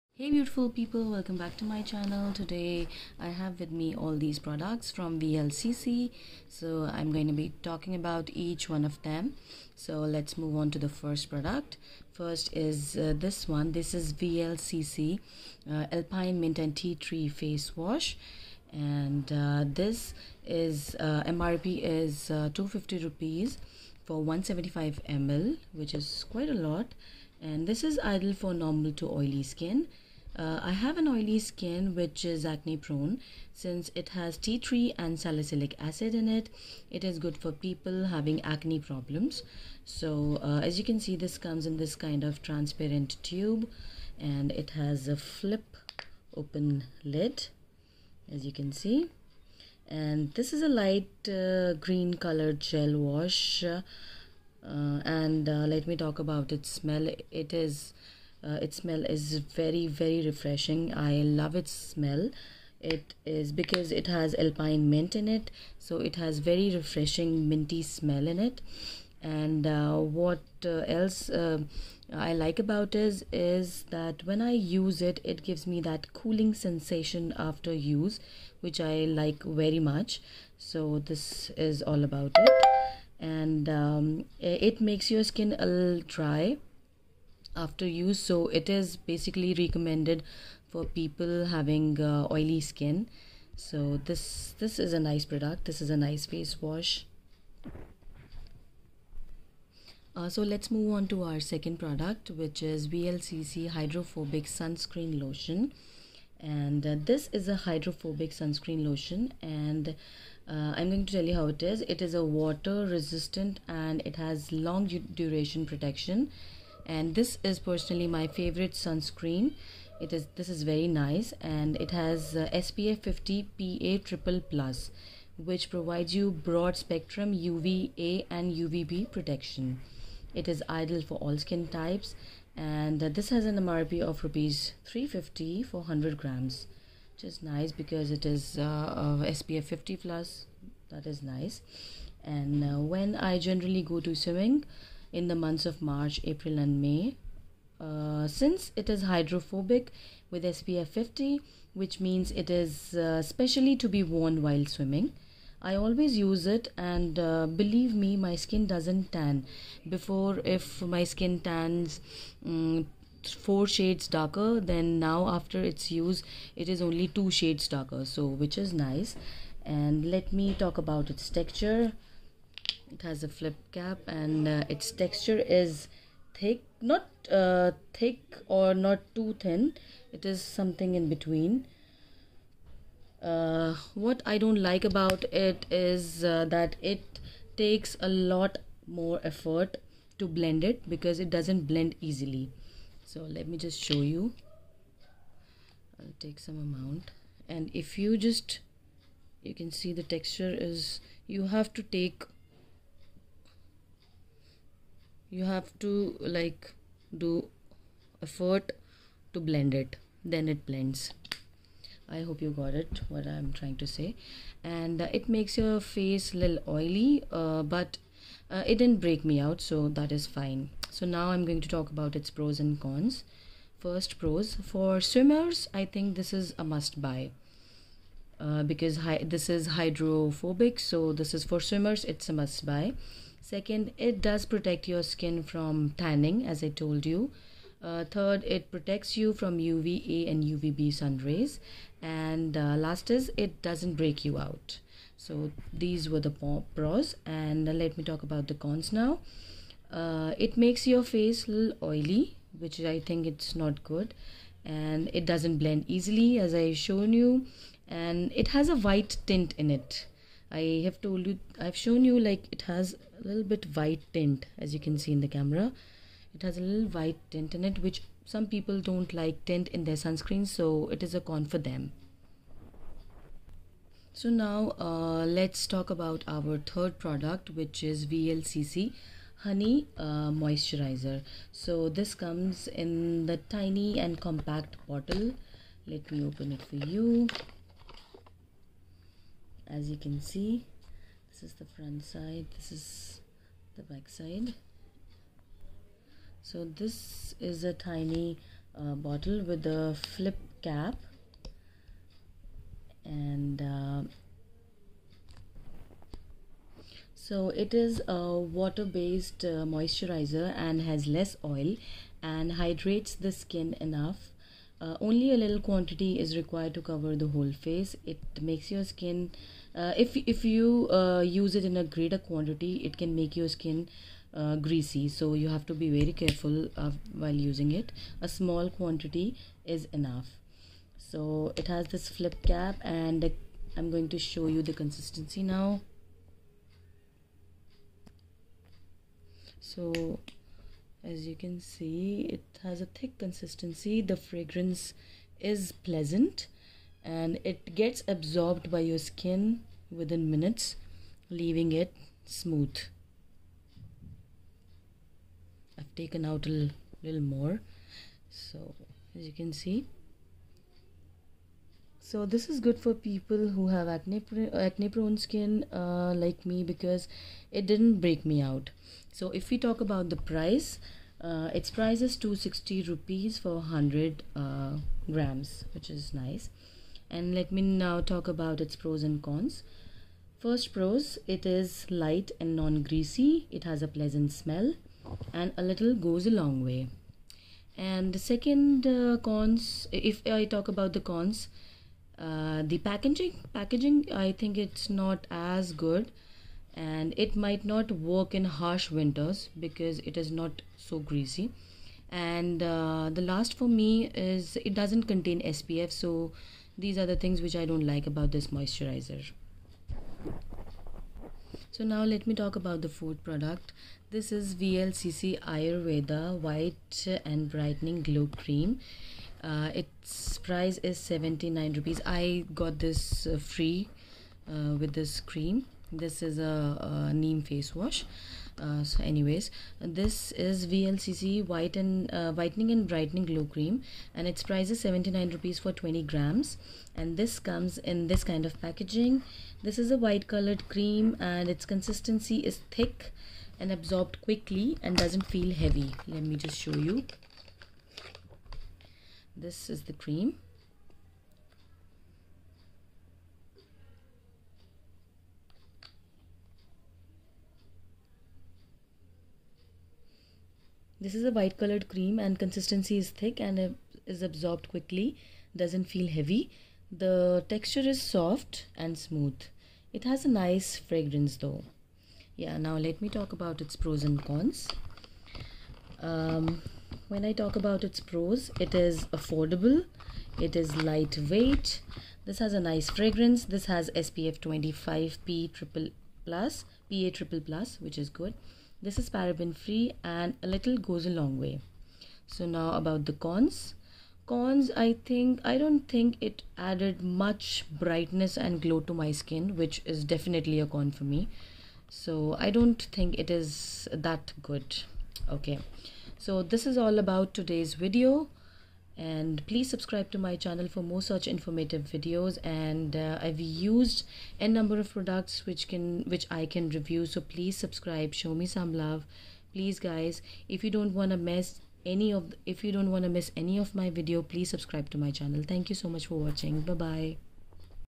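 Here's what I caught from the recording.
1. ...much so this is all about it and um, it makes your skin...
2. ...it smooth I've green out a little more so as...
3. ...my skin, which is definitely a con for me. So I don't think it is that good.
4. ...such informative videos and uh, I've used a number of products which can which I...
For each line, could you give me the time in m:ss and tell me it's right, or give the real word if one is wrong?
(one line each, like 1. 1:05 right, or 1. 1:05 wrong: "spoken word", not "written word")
1. 1:19 right
2. 5:51 wrong: "taken", not "green"
3. 8:18 right
4. 8:31 right.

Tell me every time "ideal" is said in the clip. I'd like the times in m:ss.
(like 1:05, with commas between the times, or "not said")
0:28, 2:10.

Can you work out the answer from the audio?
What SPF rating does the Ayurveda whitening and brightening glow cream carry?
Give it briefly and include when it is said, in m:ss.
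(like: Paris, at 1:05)
SPF 25, at 8:03.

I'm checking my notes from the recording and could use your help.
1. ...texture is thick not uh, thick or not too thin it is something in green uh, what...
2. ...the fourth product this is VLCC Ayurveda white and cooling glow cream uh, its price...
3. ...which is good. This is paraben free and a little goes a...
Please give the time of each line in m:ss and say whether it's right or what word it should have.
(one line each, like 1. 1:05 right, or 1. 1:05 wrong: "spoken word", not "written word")
1. 2:54 wrong: "between", not "green"
2. 6:52 wrong: "brightening", not "cooling"
3. 8:07 right.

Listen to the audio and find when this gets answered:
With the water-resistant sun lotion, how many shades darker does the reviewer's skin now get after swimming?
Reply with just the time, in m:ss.
2:47.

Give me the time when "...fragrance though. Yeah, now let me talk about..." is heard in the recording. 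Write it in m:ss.
7:50.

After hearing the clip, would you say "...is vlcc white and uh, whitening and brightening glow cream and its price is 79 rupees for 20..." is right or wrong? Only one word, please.
right.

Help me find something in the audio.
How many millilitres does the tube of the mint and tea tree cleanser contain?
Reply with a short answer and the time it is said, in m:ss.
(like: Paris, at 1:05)
175 ml, at 0:24.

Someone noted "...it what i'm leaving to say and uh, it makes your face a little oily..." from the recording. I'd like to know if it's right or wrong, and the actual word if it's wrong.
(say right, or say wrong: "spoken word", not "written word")
wrong: "trying", not "leaving".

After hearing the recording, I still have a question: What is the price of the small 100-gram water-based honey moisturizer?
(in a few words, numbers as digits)
260 rupees.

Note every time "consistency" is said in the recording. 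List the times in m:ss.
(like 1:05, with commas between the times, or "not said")
5:34, 5:43, 7:21, 7:42.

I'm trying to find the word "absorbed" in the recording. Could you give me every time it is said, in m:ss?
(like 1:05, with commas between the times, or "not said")
5:48, 7:23, 7:44.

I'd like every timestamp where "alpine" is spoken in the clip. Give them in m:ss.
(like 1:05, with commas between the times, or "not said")
0:15, 1:04.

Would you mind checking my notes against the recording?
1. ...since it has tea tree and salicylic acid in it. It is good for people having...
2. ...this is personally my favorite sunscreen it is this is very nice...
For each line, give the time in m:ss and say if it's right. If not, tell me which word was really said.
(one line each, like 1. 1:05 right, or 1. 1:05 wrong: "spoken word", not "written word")
1. 0:33 right
2. 1:57 right.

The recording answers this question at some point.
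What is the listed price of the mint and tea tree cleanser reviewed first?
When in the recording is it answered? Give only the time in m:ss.
0:22.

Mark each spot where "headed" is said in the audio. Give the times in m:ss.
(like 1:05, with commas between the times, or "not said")
not said.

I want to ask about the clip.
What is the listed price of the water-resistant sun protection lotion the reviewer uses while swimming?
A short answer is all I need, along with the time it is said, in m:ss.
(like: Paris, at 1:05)
350 rupees, at 2:14.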